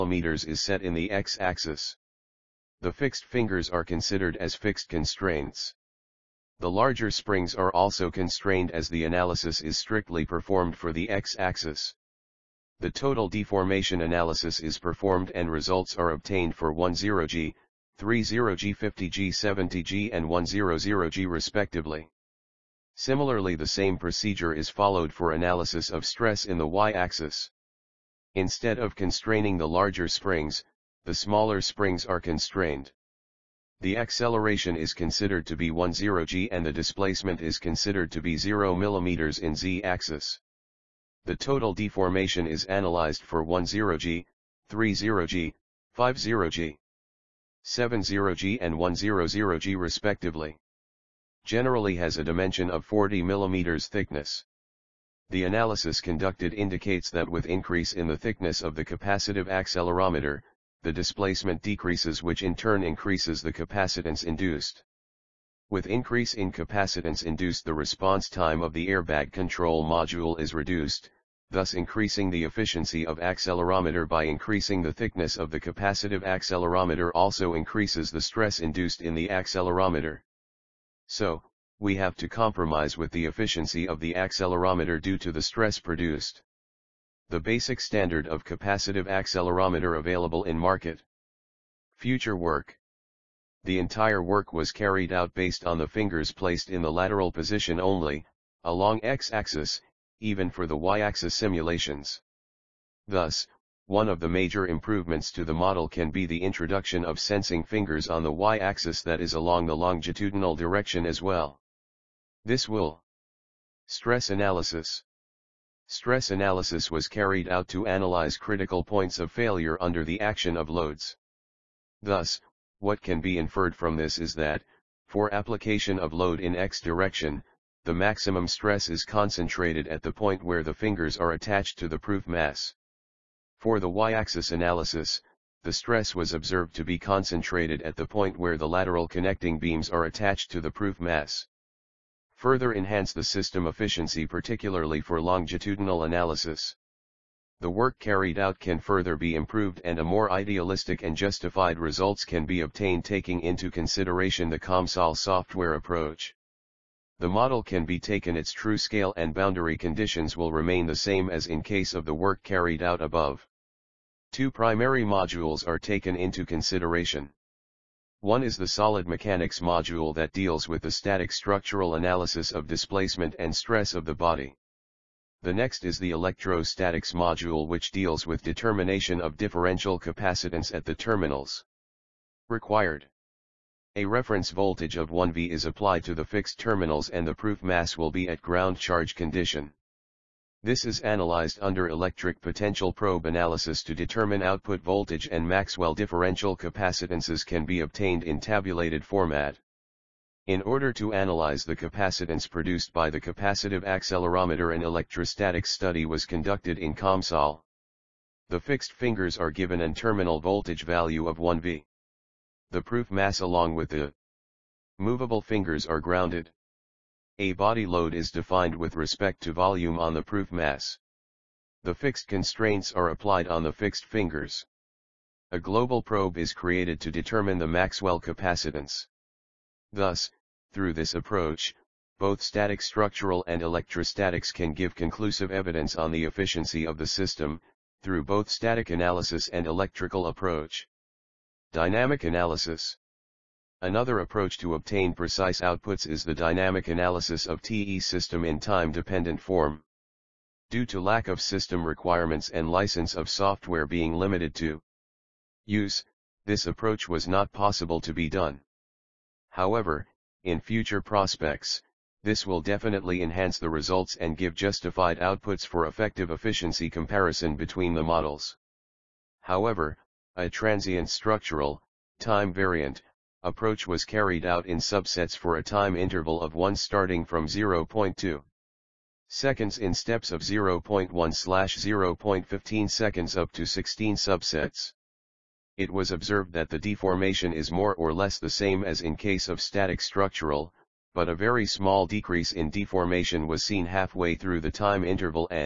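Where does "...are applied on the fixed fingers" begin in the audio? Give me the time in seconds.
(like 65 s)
222 s.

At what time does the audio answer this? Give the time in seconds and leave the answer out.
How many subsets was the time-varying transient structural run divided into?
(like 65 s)
283 s.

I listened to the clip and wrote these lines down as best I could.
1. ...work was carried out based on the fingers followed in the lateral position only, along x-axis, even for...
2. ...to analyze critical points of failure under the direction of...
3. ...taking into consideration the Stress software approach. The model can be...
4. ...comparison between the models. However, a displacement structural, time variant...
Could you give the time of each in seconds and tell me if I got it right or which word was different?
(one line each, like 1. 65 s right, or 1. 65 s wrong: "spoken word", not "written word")
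1. 94 s wrong: "placed", not "followed"
2. 117 s wrong: "action", not "direction"
3. 153 s wrong: "COMSOL", not "Stress"
4. 266 s wrong: "transient", not "displacement".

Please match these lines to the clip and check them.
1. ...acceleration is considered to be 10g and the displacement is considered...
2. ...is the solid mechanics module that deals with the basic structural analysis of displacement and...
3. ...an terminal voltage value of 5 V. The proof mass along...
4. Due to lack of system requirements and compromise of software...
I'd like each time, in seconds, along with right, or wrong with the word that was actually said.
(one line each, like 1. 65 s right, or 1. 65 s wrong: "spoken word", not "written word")
1. 33 s right
2. 168 s wrong: "static", not "basic"
3. 209 s wrong: "1", not "5"
4. 250 s wrong: "license", not "compromise".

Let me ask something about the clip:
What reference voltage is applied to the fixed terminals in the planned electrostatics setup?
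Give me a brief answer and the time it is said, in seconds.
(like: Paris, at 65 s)
1V, at 185 s.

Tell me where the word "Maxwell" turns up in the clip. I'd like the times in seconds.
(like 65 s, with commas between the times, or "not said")
195 s, 227 s.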